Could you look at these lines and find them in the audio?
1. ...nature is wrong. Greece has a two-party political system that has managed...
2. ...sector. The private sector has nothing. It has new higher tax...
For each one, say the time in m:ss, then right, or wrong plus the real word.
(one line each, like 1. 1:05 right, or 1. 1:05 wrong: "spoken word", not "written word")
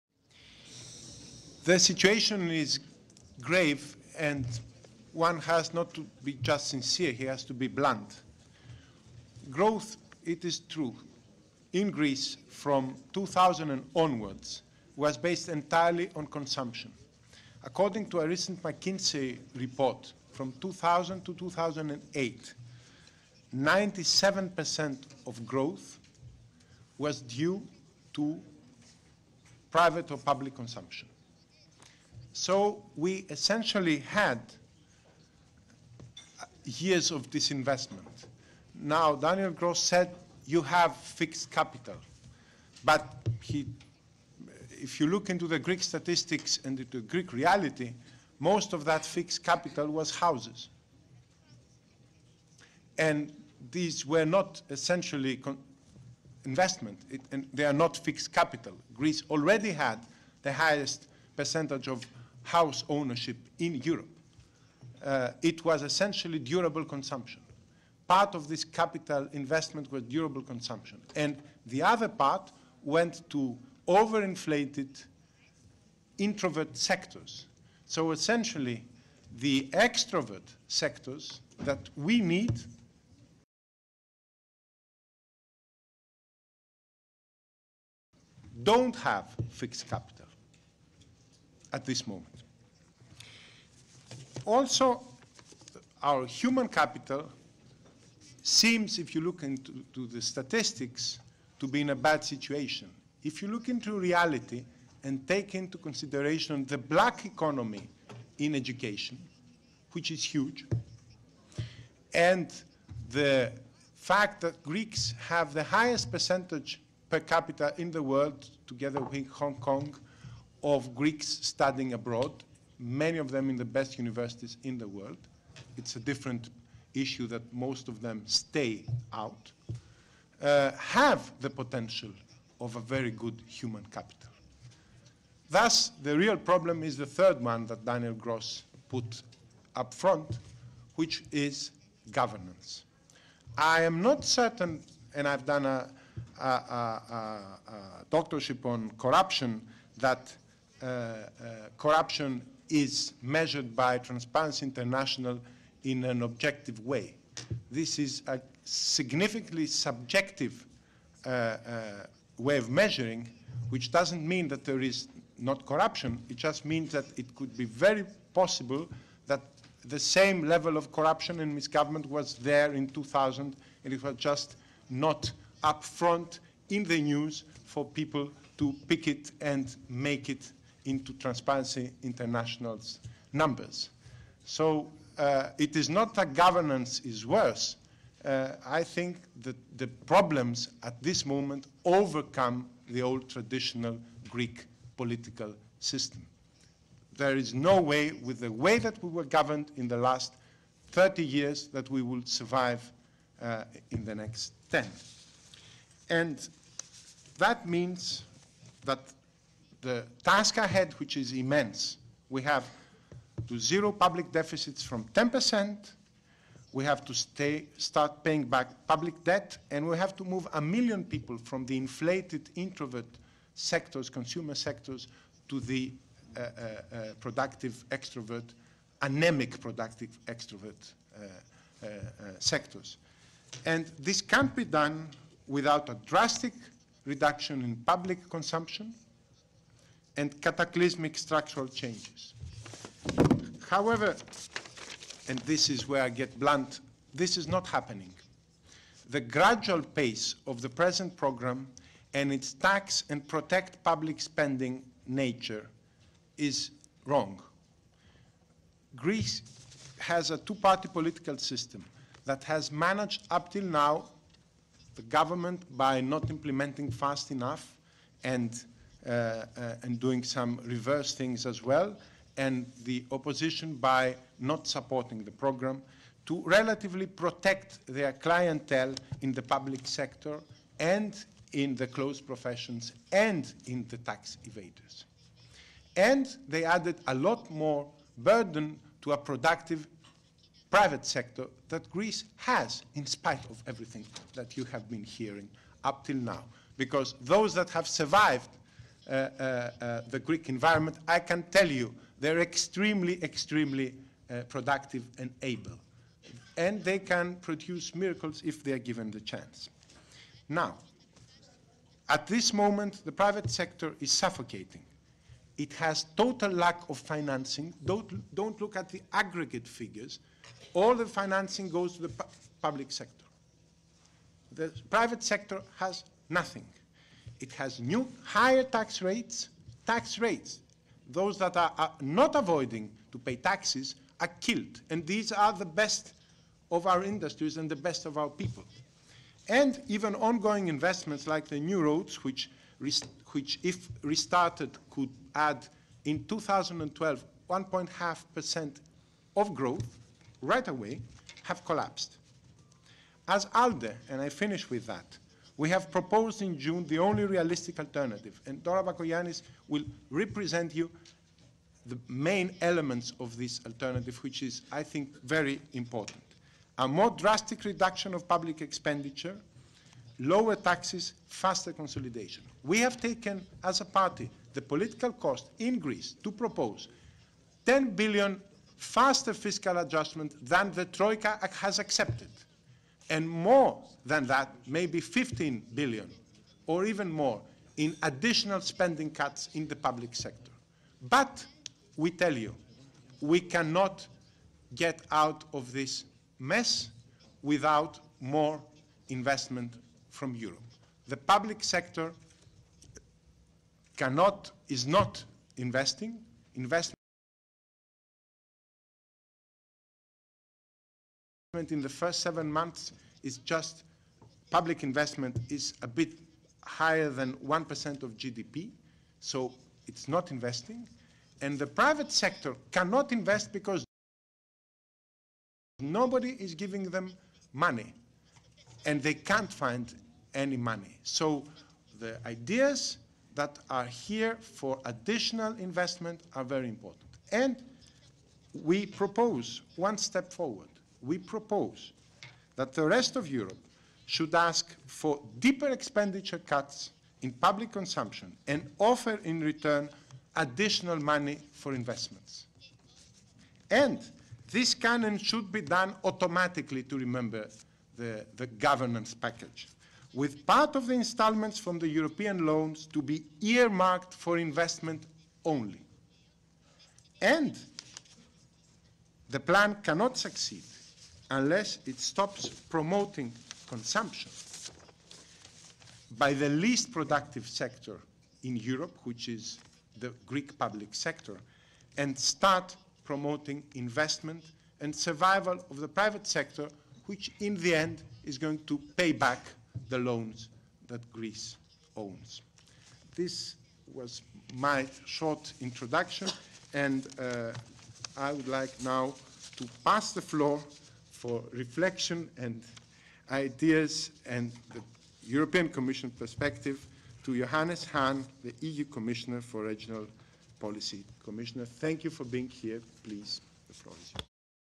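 1. 4:15 right
2. 5:22 right.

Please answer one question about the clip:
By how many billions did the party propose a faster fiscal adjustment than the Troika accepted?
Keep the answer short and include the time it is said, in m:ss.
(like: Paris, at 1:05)
10 billion, at 6:17.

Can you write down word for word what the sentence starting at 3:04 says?
So uh, it is not that governance is worse.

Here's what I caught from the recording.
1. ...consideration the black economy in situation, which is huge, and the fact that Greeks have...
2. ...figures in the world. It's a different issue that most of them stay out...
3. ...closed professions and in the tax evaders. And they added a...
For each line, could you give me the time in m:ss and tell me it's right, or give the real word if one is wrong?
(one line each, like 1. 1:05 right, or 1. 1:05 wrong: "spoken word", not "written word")
1. 1:45 wrong: "education", not "situation"
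2. 2:03 wrong: "universities", not "figures"
3. 4:41 right.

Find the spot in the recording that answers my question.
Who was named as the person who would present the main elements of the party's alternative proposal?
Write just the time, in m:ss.
5:58.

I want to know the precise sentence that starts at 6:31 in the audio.
But we tell you, we cannot get out of this mess without more investment from Europe.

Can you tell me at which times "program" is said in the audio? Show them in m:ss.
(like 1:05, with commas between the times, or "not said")
4:11, 4:35.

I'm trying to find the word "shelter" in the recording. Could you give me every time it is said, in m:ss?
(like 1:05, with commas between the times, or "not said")
not said.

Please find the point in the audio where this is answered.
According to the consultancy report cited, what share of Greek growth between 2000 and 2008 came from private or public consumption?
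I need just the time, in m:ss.
0:23.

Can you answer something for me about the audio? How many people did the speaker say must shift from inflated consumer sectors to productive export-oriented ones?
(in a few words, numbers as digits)
1 million.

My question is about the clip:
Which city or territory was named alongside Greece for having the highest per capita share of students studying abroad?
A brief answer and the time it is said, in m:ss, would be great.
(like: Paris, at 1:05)
Hong Kong, at 1:59.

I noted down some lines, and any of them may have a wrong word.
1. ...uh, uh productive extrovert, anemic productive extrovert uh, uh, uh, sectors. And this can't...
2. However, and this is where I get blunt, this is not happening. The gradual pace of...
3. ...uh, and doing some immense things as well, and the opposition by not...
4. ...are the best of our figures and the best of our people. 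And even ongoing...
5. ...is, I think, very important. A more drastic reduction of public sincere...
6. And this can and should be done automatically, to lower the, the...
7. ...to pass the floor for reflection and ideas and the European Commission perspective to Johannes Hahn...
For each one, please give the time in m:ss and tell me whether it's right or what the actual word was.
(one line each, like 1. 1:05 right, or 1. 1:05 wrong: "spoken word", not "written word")
1. 3:46 right
2. 4:03 right
3. 4:29 wrong: "reverse", not "immense"
4. 5:35 wrong: "industries", not "figures"
5. 6:04 wrong: "expenditure", not "sincere"
6. 7:33 wrong: "remember", not "lower"
7. 8:19 right.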